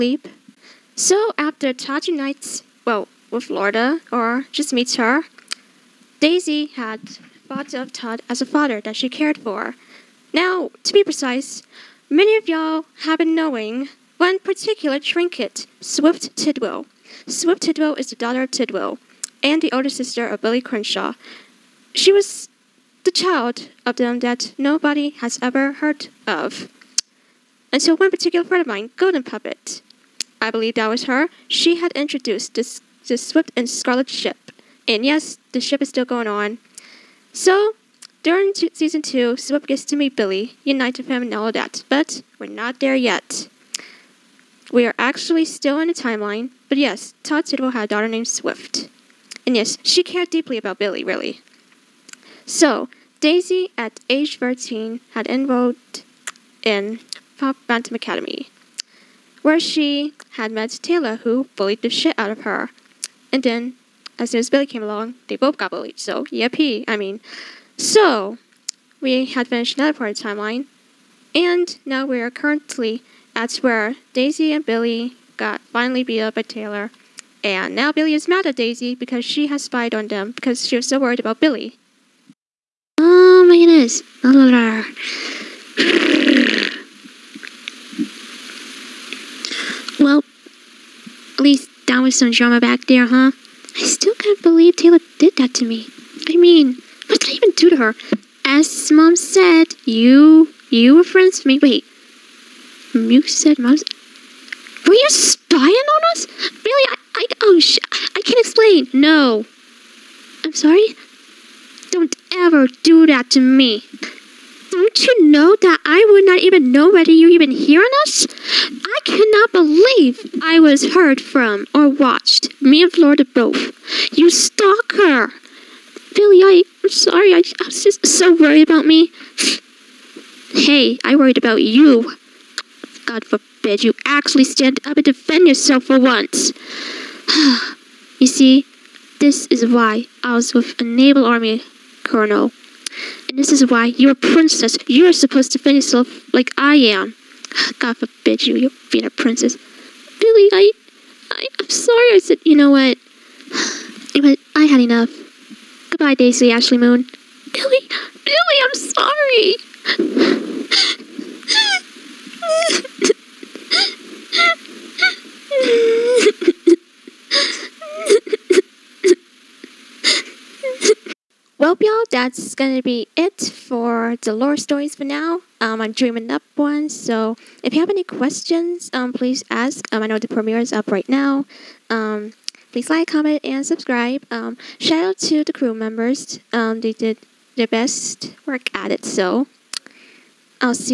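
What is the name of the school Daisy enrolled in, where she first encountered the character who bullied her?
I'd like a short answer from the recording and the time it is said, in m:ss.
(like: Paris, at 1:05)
Pop Phantom Academy, at 0:57.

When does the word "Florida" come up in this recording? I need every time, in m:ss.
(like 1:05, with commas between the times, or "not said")
0:03, 2:02.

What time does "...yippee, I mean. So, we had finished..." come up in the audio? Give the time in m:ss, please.
1:06.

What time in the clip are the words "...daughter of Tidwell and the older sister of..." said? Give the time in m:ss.
0:18.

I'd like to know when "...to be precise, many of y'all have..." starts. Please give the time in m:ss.
0:10.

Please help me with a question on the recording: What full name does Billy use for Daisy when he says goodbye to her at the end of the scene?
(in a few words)
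Daisy Ashley Moon.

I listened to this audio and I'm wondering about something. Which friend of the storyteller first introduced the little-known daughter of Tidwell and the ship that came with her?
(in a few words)
Golden Puppet.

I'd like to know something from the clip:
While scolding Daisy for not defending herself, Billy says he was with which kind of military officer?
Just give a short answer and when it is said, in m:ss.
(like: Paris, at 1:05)
naval army colonel, at 2:20.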